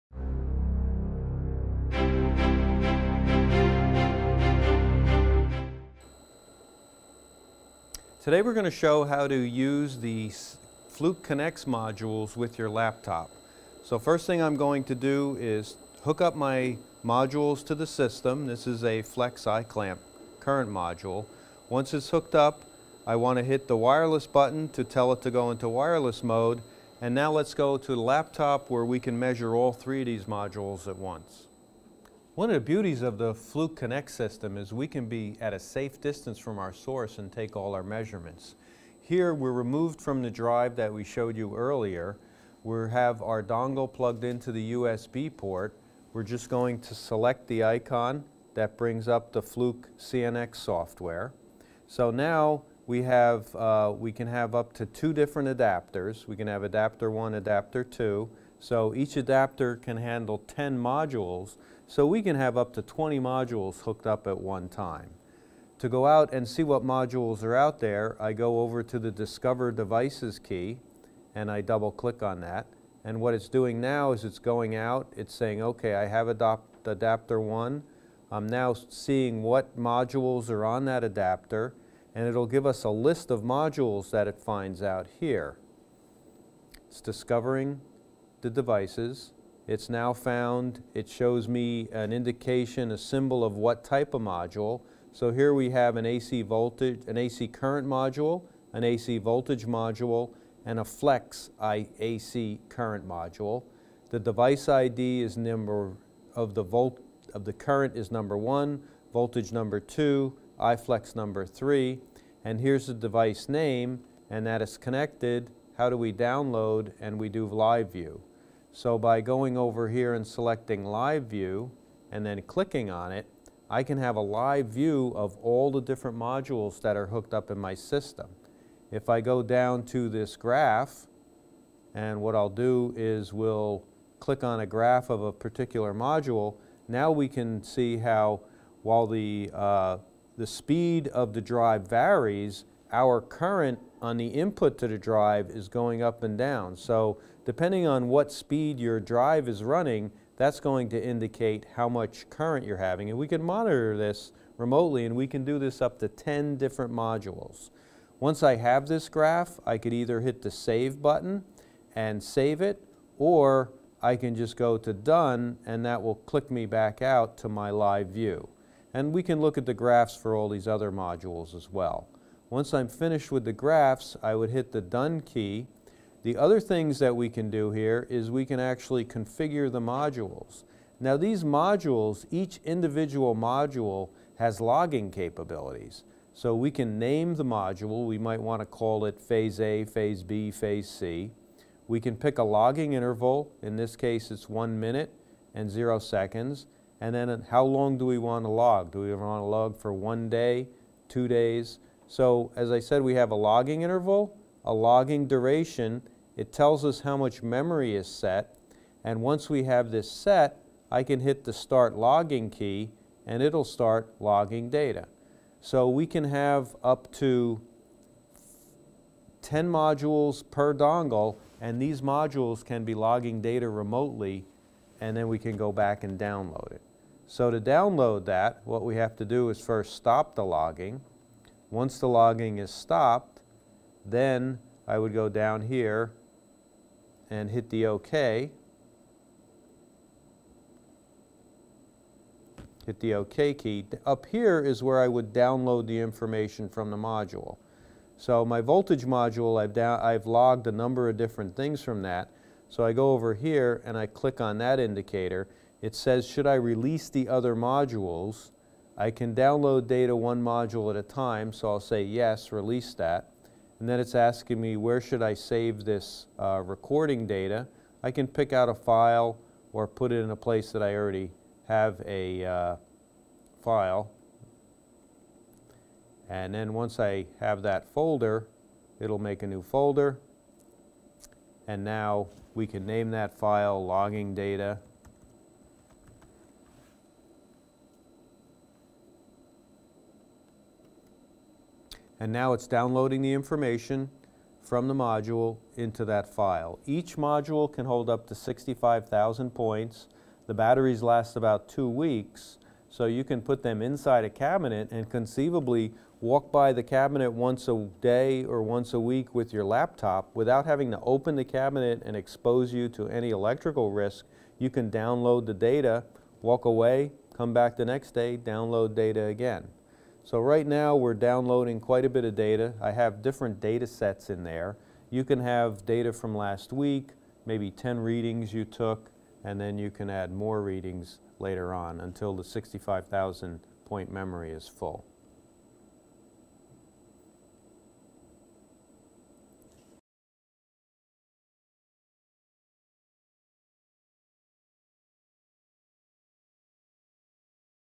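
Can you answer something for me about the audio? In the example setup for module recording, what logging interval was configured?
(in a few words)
1 minute.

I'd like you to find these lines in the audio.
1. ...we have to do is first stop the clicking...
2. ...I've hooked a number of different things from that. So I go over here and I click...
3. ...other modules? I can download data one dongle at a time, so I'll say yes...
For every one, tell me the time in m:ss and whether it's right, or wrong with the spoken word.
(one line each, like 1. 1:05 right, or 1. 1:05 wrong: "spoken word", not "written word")
1. 3:48 wrong: "logging", not "clicking"
2. 4:10 wrong: "logged", not "hooked"
3. 4:17 wrong: "module", not "dongle".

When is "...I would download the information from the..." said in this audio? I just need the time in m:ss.
4:05.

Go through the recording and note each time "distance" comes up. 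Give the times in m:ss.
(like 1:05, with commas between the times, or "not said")
0:36.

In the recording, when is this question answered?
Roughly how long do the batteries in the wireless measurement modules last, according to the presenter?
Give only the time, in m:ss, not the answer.
5:01.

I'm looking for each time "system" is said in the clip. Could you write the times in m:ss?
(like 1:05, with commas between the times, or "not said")
0:17, 0:34, 2:07.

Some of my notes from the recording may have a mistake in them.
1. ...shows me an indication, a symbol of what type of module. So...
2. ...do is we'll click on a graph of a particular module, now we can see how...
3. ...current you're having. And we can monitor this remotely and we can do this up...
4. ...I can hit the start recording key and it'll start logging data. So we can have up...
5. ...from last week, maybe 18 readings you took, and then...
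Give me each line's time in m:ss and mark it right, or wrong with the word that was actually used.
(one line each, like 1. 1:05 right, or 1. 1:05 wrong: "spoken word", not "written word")
1. 1:31 right
2. 2:12 right
3. 2:32 right
4. 3:30 wrong: "logging", not "recording"
5. 5:26 wrong: "10", not "18".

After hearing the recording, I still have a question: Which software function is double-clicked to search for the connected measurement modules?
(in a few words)
Discover Devices.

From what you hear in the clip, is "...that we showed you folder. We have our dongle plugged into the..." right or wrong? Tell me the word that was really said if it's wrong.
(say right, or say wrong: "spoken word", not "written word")
wrong: "earlier", not "folder".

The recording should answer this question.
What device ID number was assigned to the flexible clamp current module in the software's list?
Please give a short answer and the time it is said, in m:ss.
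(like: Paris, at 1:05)
3, at 1:50.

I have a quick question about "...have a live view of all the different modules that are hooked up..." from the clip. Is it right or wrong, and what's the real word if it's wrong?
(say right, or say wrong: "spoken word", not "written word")
right.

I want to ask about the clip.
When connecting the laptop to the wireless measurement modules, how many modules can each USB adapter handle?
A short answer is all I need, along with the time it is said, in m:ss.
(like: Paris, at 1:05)
10, at 0:58.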